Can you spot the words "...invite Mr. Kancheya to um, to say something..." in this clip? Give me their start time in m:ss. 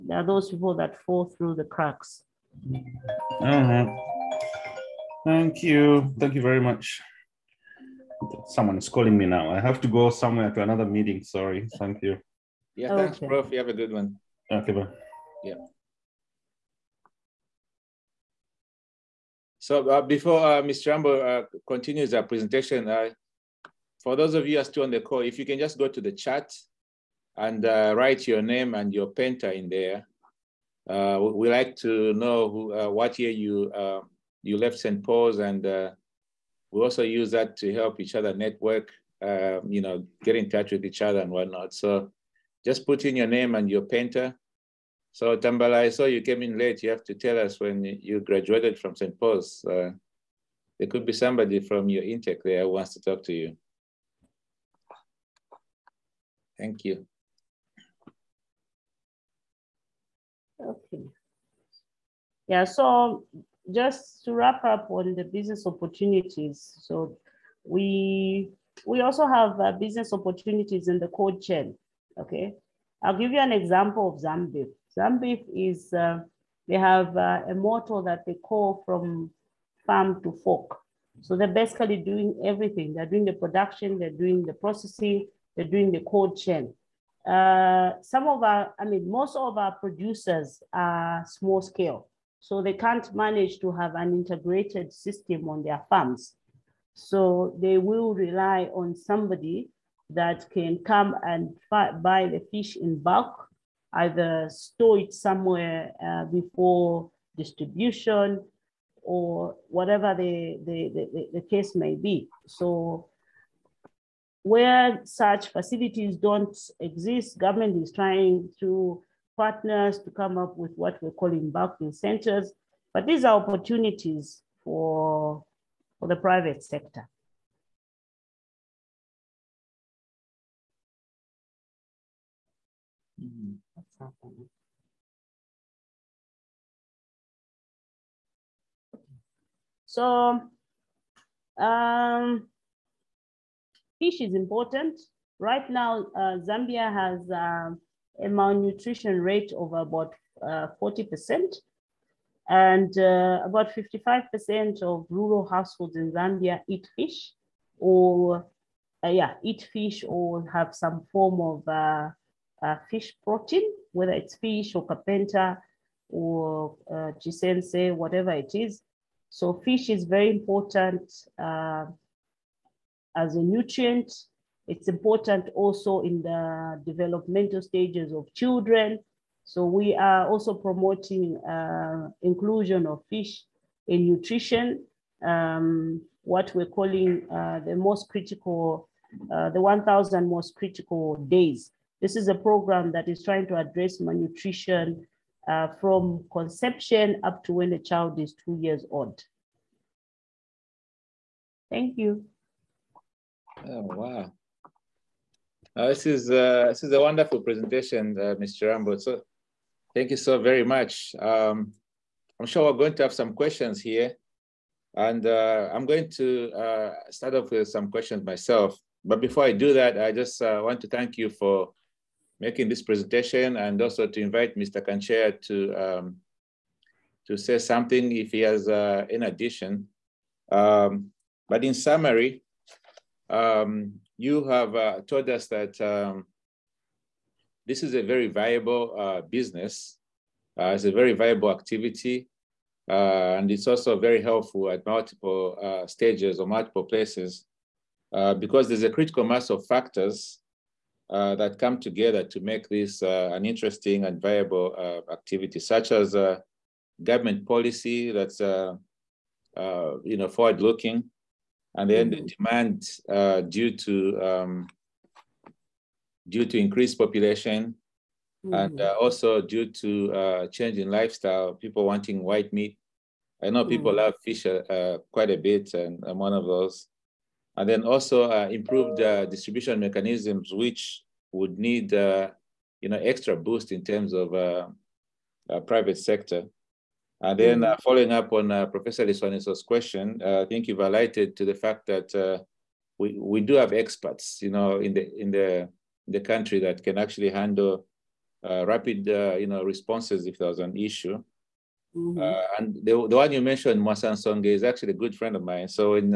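3:44.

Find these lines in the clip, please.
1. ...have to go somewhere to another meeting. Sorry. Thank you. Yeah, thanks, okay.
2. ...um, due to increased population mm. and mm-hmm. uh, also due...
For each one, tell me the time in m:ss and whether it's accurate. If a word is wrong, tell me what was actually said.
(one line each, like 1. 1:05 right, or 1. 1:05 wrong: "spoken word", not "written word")
1. 0:09 right
2. 4:24 right.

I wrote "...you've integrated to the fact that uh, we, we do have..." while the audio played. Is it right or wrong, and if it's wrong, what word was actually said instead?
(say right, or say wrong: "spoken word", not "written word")
wrong: "highlighted", not "integrated".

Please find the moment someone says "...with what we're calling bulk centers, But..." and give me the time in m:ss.
2:00.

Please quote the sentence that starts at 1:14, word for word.
Zambeef is uh, they have uh, a motto that they call from farm to fork.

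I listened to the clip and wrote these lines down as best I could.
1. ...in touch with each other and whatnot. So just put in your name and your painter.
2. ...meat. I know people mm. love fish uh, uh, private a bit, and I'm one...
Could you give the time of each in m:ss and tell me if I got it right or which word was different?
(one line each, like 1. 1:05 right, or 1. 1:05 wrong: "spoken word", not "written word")
1. 0:40 right
2. 4:32 wrong: "quite", not "private".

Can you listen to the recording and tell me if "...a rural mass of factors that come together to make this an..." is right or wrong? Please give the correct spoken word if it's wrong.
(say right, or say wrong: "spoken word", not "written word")
wrong: "critical", not "rural".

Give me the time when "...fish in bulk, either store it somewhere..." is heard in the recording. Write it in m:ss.
1:42.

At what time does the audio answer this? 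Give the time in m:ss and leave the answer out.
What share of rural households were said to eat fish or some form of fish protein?
2:33.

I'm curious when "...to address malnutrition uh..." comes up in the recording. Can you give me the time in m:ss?
3:13.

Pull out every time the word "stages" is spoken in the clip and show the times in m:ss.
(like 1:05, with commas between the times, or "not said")
2:57, 4:05.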